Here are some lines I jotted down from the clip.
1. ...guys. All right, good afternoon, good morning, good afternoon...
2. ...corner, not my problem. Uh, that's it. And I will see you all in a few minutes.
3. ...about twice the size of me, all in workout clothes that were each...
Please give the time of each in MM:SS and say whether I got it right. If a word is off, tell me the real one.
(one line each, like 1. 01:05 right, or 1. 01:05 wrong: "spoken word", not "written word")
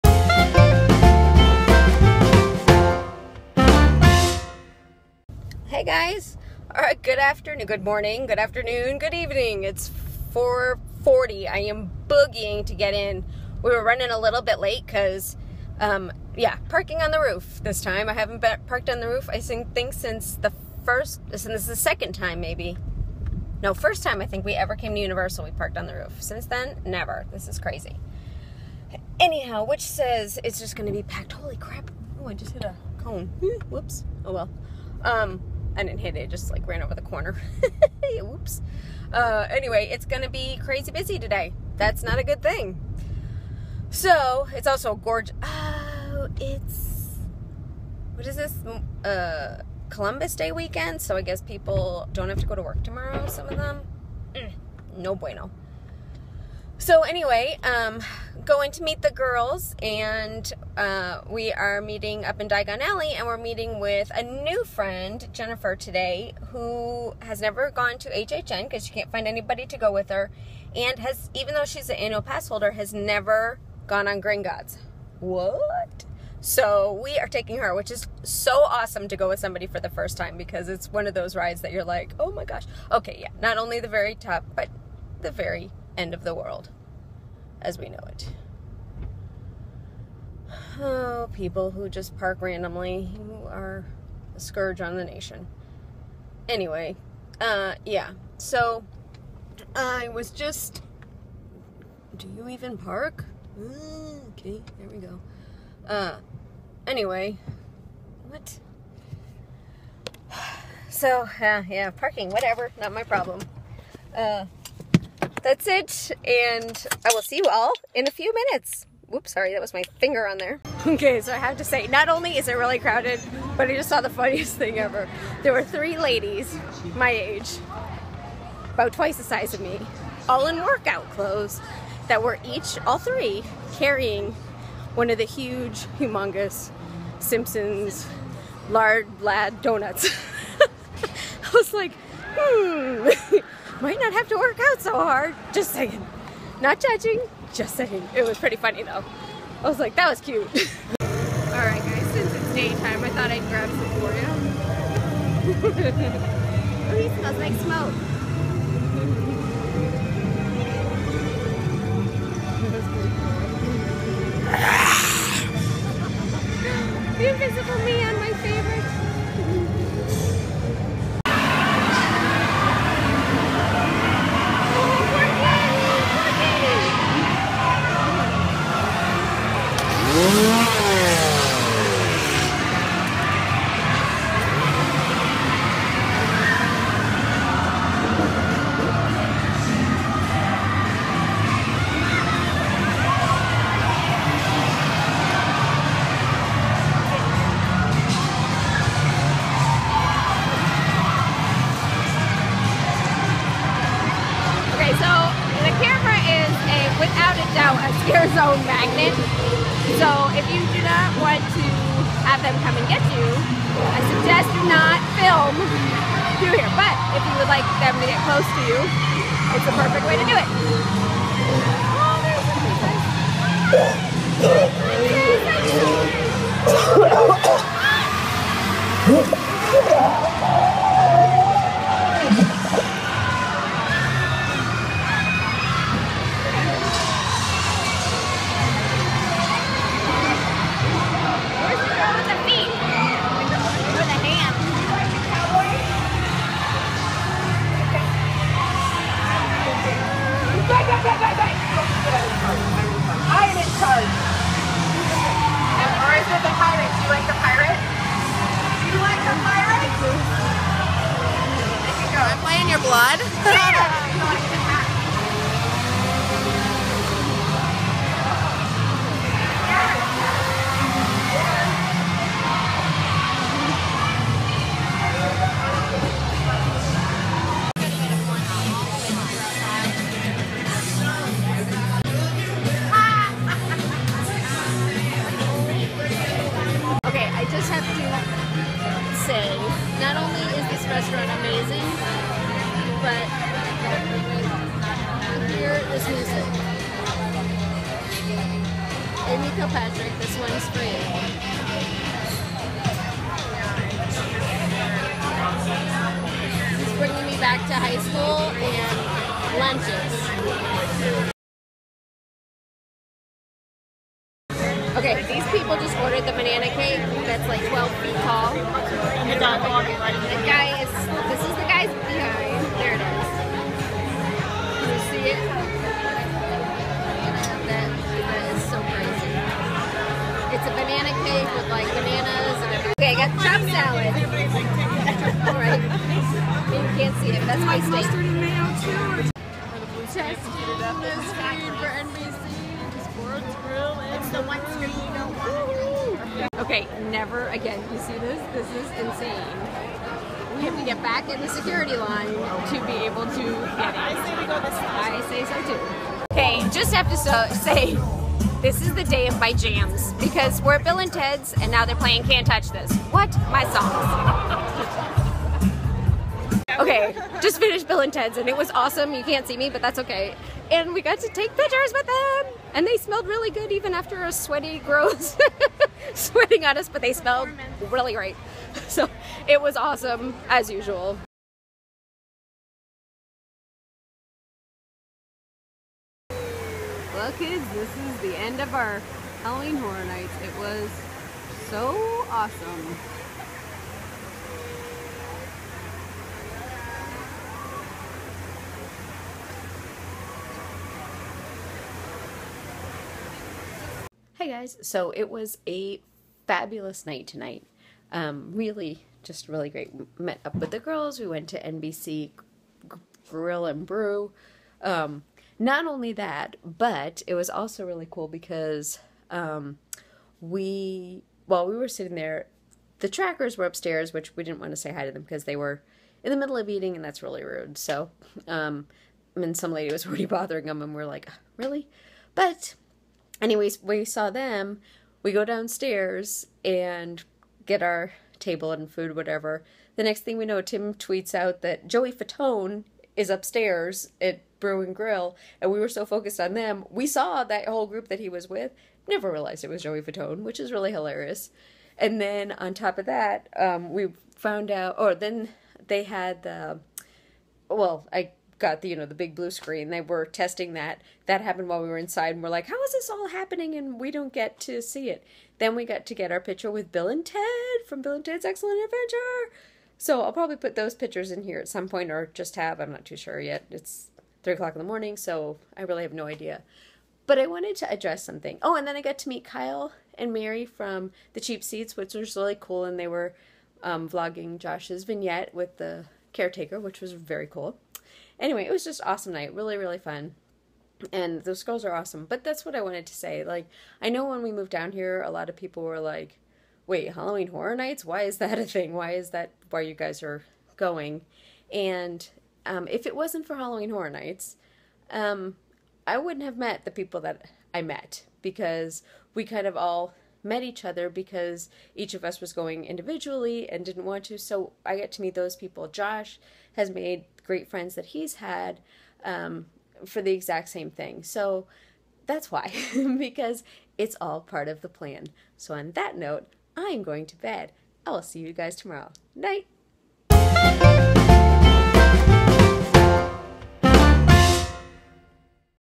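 1. 00:05 right
2. 01:52 wrong: "whatever", not "corner"
3. 02:08 right.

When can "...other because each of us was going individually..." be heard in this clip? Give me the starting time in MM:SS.
08:30.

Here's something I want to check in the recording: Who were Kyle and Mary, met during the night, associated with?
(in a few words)
The Cheap Seats.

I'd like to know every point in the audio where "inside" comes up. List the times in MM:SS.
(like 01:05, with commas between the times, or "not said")
07:41.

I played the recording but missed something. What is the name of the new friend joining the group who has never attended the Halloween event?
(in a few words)
Jennifer.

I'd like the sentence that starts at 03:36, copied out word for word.
But if you would like them to get close to you, it's the perfect way to do it.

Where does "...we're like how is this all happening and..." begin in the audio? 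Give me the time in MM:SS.
07:42.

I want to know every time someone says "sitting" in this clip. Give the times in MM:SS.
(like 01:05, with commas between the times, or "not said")
07:01.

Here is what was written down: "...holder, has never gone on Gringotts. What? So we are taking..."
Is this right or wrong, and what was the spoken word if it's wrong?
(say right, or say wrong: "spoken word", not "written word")
right.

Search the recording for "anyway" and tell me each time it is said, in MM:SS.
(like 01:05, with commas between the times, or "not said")
00:39, 00:57, 01:36, 01:46, 07:13, 08:08.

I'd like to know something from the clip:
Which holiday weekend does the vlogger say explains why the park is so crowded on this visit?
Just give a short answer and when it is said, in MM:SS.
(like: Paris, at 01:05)
Columbus Day weekend, at 00:49.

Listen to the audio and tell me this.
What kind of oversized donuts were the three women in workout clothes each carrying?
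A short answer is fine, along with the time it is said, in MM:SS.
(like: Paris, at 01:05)
Simpsons Lard Lad donuts, at 02:17.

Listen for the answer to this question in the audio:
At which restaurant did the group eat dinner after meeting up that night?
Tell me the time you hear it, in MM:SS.
06:51.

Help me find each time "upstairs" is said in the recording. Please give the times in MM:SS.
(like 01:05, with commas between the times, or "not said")
07:03, 07:23.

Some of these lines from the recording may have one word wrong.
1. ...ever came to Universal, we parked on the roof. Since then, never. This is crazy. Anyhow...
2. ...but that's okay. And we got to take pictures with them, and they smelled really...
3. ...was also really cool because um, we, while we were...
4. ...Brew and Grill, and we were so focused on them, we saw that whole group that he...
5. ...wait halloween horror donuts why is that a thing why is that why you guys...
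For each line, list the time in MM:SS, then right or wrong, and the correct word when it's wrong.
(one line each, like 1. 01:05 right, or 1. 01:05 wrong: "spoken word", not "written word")
1. 00:24 right
2. 06:09 right
3. 06:57 right
4. 07:24 right
5. 08:16 wrong: "nights", not "donuts".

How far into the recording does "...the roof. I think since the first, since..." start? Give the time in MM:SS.
00:18.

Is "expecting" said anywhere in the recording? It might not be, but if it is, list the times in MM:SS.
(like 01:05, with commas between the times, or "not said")
not said.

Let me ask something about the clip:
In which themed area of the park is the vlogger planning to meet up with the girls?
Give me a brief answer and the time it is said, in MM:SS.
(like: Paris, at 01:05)
Diagon Alley, at 01:02.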